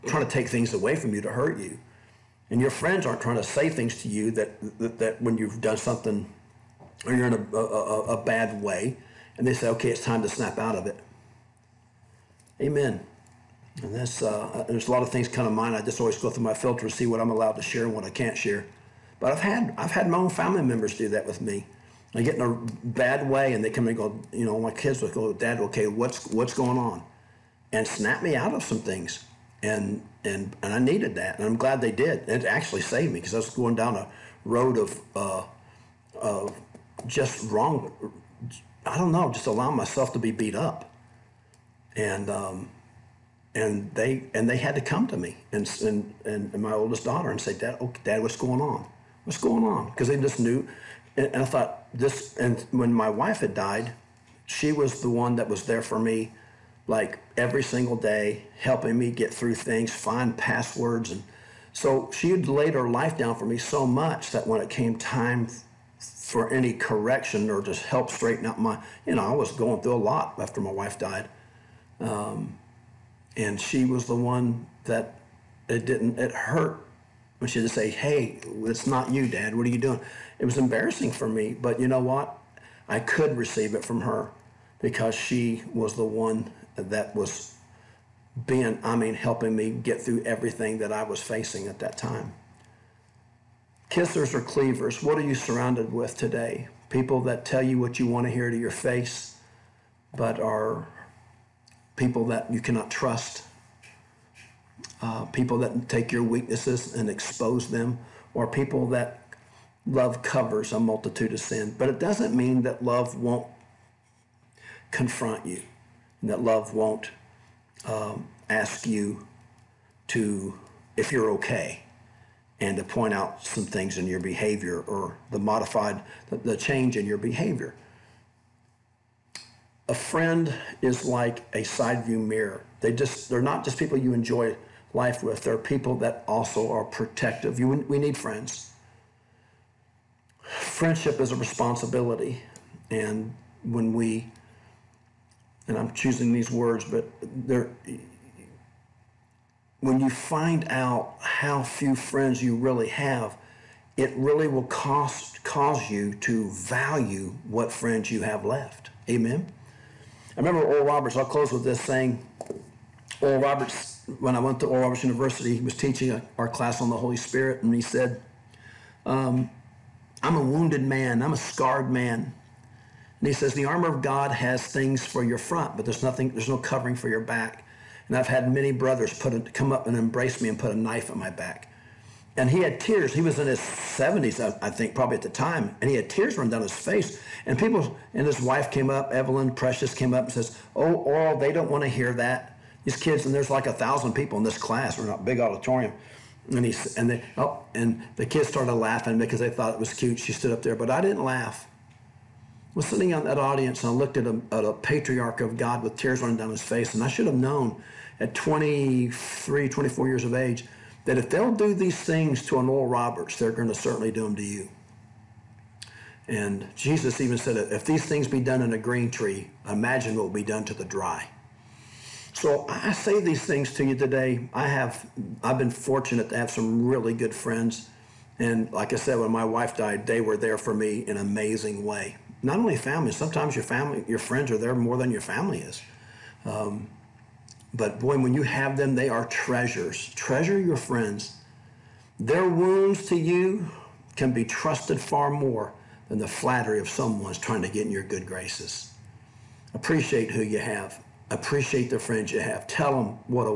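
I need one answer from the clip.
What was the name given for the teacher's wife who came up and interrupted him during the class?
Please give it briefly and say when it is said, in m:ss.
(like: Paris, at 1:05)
Evelyn, at 3:09.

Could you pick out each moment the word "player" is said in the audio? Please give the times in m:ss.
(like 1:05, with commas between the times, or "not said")
not said.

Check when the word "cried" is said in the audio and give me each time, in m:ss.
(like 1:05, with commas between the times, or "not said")
not said.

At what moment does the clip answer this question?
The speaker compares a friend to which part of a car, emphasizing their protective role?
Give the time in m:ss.
2:11.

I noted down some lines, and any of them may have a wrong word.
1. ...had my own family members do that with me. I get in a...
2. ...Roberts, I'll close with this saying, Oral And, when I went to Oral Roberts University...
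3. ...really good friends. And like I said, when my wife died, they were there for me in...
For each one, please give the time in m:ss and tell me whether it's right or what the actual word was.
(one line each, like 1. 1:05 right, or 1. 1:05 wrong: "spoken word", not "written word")
1. 0:19 right
2. 2:40 wrong: "Roberts", not "And"
3. 3:46 right.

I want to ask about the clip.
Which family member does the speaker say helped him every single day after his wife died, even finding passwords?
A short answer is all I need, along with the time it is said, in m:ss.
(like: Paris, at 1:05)
Oldest daughter, at 0:46.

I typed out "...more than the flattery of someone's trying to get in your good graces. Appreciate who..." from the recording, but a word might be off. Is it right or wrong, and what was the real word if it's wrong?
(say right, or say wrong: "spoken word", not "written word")
right.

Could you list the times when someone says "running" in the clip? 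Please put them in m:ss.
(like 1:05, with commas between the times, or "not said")
3:06, 3:26.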